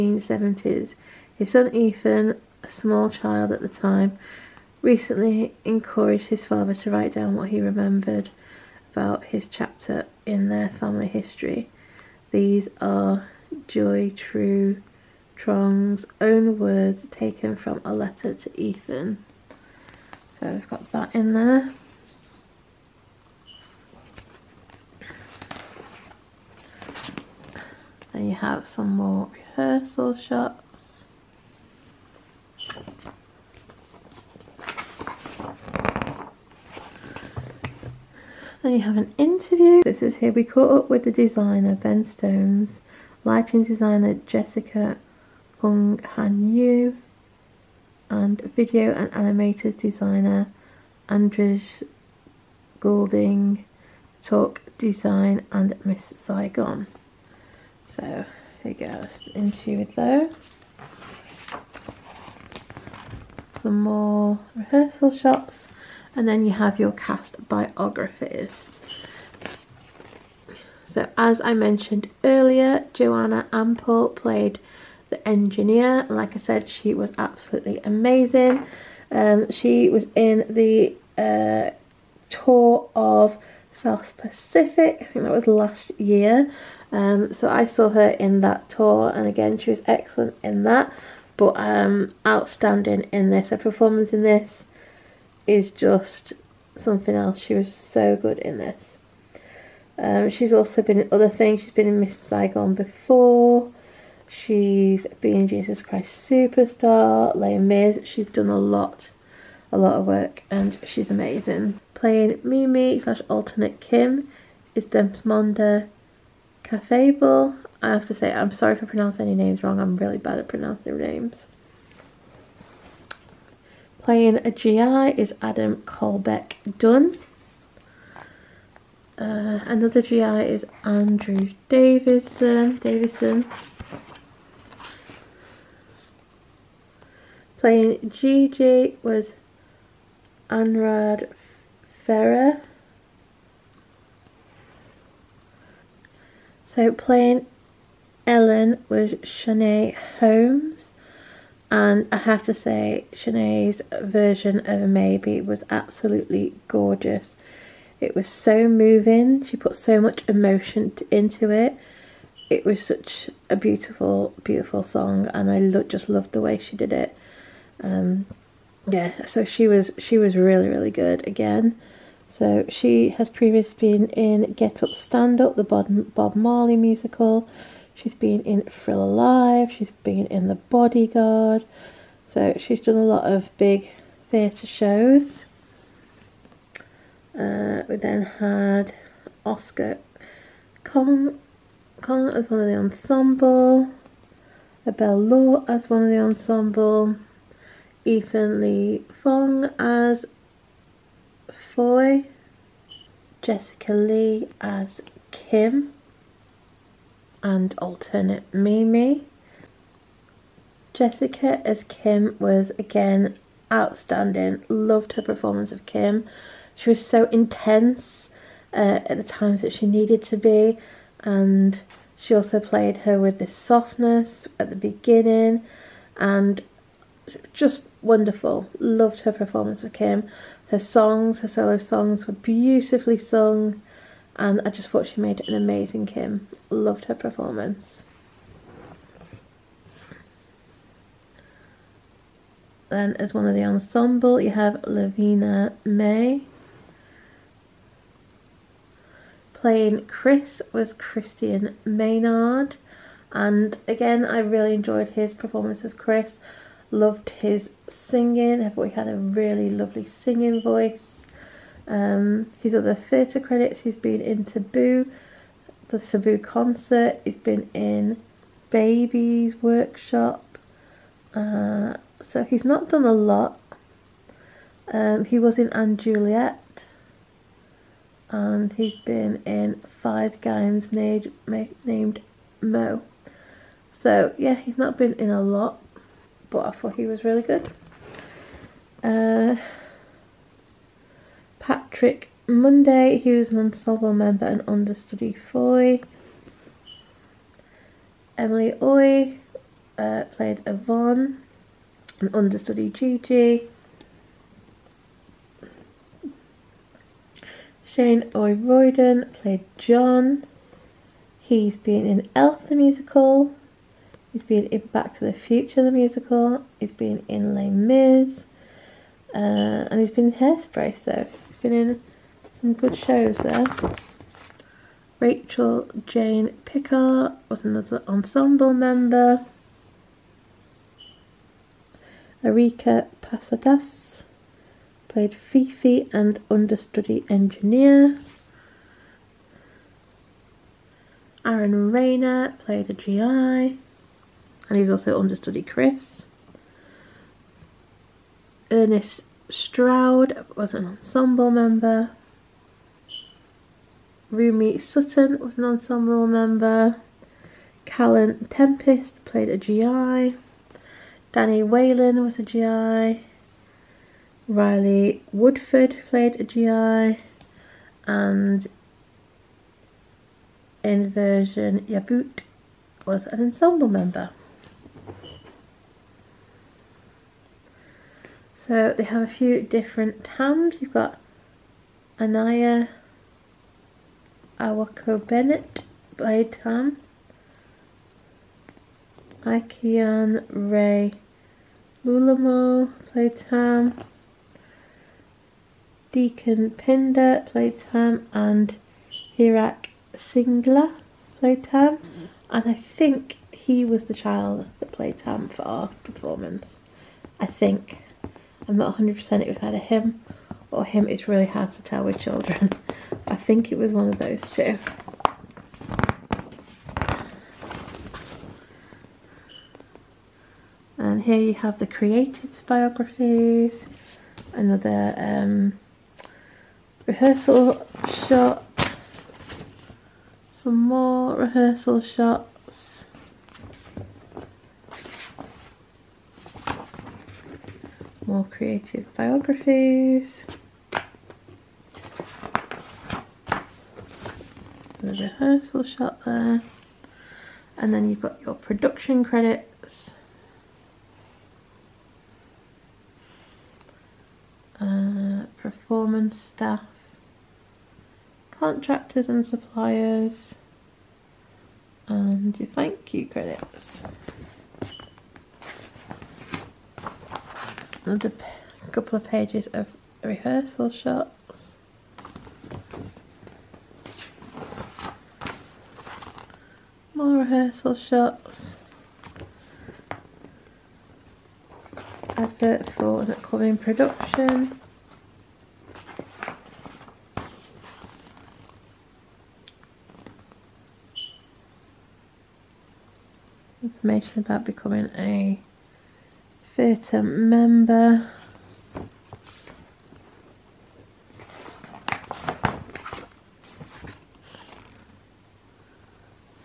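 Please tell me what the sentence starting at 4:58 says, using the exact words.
Emily Oy uh, played Yvonne an understudy Gigi.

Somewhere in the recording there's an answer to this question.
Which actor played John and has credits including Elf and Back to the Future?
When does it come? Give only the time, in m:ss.
5:07.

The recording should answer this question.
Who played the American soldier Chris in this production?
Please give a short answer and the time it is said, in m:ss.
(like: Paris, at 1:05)
Christian Maynard, at 4:10.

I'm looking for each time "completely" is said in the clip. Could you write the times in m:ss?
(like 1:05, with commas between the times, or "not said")
not said.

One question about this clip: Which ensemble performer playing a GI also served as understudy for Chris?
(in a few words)
Aaron Rayner.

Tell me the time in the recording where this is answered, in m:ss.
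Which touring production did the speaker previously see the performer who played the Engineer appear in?
1:23.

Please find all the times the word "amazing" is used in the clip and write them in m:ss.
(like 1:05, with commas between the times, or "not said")
1:17, 1:51, 3:55.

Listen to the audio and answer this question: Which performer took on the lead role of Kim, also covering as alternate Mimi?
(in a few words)
Jessica Lee.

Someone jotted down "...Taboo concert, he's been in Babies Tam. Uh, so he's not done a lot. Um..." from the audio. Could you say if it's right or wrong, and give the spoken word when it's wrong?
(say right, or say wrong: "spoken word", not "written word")
wrong: "Workshop", not "Tam".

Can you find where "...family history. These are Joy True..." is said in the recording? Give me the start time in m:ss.
0:10.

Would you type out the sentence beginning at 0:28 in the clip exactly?
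And you have some more rehearsal shots.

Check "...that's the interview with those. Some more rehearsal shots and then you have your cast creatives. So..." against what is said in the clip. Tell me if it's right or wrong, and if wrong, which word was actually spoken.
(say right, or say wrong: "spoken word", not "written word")
wrong: "biographies", not "creatives".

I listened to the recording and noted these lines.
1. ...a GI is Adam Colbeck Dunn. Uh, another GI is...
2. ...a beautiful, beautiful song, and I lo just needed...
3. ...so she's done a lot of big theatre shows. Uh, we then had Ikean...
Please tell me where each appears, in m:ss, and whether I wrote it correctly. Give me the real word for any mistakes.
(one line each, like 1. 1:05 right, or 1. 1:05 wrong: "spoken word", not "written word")
1. 2:04 right
2. 2:43 wrong: "loved", not "needed"
3. 3:02 wrong: "Oscar", not "Ikean".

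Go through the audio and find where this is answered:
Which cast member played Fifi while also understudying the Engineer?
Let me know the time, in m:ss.
5:32.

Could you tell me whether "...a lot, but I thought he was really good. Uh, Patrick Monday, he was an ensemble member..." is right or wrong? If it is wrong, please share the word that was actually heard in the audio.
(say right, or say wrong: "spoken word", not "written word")
right.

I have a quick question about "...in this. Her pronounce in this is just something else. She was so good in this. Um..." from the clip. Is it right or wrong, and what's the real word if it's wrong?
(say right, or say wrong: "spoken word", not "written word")
wrong: "performance", not "pronounce".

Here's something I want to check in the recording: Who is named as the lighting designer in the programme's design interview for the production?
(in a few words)
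Jessica Hung Han Yu.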